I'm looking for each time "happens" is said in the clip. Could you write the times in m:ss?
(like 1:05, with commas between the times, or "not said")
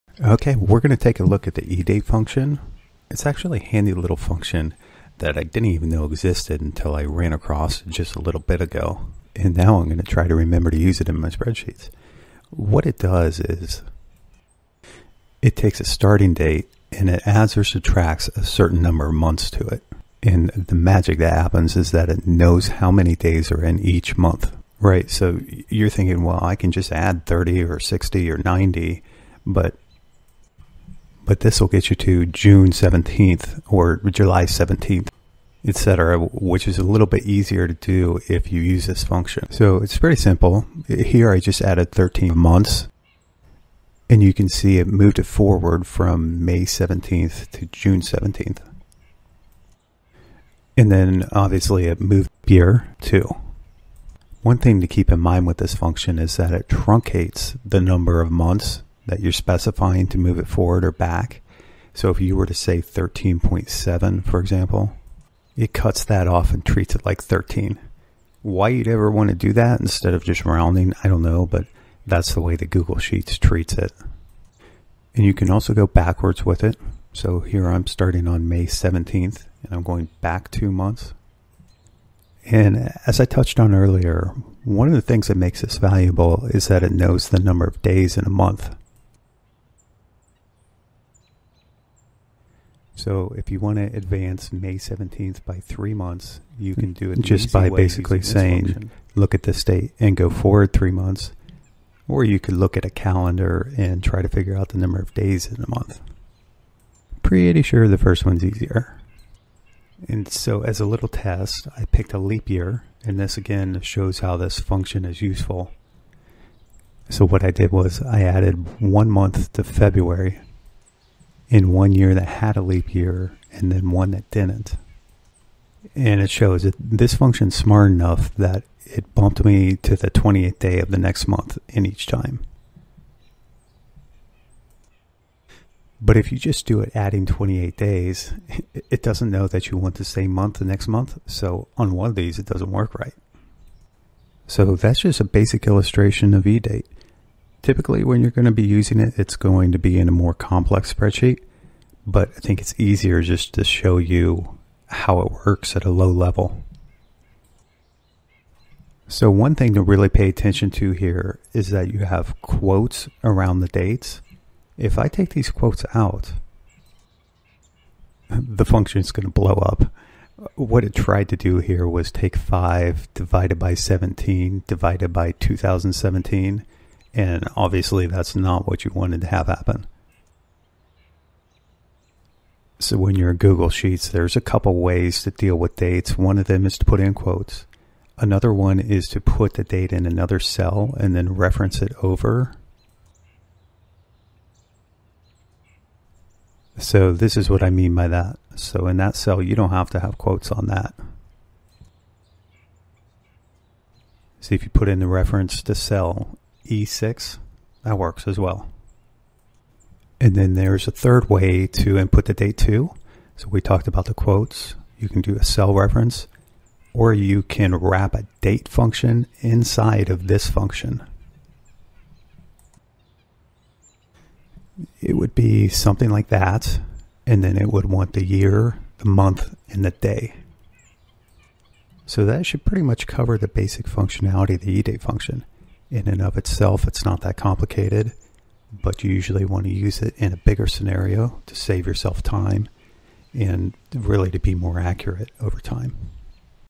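0:21, 2:59.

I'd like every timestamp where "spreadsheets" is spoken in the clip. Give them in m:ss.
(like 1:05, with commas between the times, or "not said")
0:11, 2:30.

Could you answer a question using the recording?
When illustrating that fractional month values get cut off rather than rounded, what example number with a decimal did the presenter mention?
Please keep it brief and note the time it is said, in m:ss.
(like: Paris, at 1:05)
13.7, at 1:02.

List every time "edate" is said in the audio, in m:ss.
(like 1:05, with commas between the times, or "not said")
0:01, 2:26, 3:54.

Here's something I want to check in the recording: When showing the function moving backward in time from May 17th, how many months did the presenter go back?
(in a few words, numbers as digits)
2.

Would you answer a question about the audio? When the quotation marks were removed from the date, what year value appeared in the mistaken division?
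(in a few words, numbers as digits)
2017.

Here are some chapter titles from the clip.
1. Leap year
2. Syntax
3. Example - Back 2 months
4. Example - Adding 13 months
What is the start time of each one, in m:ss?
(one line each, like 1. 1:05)
1. 1:49
2. 2:39
3. 1:15
4. 0:39.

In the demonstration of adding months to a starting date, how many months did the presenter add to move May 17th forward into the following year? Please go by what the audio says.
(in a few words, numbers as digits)
13.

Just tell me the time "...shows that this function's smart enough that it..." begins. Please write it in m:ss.
2:06.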